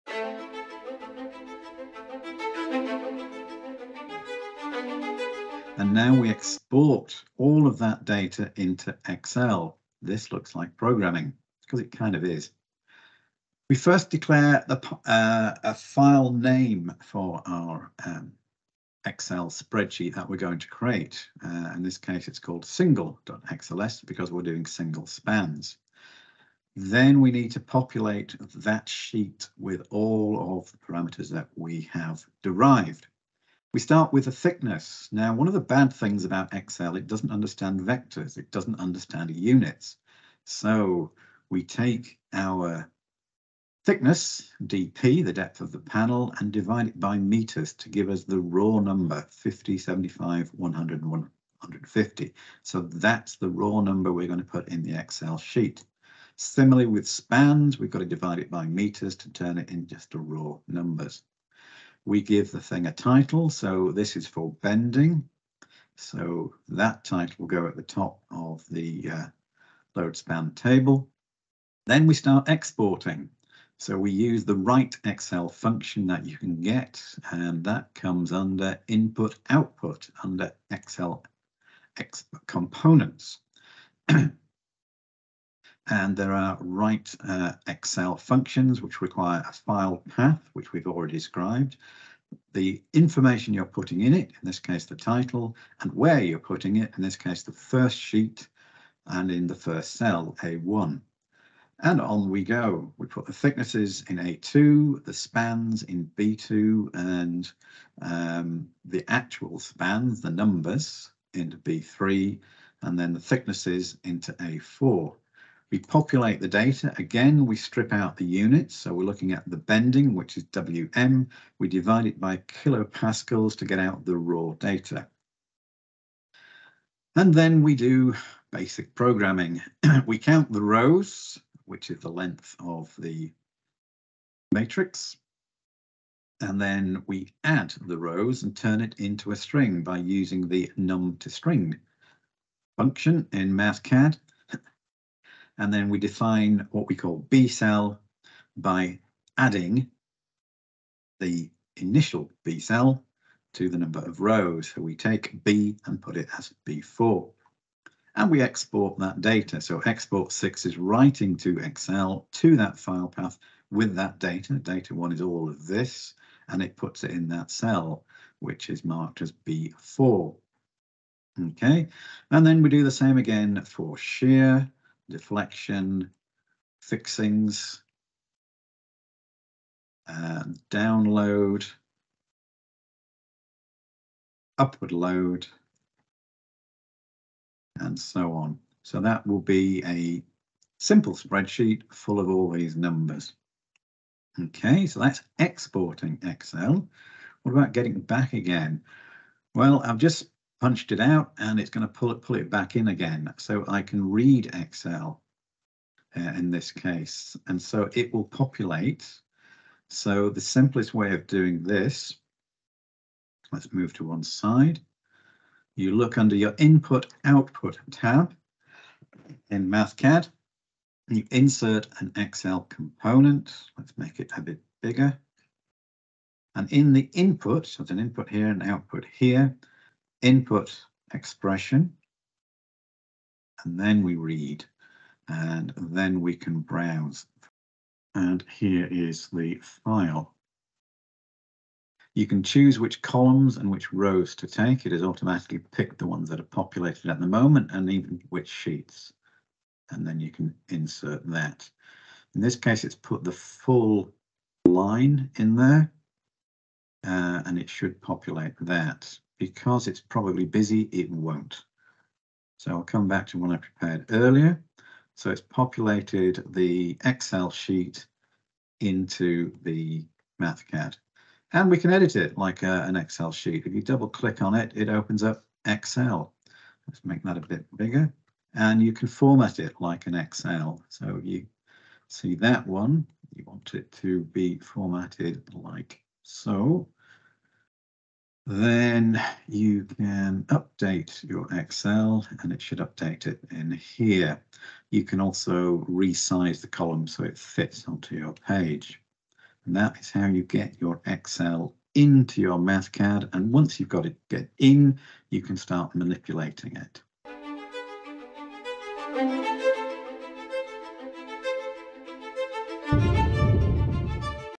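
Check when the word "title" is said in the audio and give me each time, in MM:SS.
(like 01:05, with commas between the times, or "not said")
01:02, 01:07, 01:34.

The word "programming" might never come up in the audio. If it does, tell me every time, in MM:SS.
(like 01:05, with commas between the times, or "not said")
00:10, 02:08.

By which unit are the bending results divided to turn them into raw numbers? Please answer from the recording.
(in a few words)
kilopascals.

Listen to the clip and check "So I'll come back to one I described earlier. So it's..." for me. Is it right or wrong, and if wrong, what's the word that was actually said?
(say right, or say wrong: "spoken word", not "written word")
wrong: "prepared", not "described".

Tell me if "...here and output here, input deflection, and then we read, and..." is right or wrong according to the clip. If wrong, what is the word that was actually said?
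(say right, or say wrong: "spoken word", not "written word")
wrong: "expression", not "deflection".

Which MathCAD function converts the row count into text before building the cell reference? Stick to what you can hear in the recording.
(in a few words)
num to string.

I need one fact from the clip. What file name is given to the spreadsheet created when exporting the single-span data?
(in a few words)
single.xls.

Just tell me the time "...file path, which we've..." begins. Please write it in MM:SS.
01:29.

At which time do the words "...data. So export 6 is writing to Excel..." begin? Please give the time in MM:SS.
02:39.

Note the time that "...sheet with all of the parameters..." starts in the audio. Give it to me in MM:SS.
00:28.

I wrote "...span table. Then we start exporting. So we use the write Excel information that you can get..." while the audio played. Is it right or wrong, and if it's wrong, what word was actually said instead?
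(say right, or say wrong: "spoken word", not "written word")
wrong: "function", not "information".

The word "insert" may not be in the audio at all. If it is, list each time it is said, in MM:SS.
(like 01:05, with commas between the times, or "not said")
03:41, 04:10.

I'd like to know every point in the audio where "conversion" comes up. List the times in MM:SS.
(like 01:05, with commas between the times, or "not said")
not said.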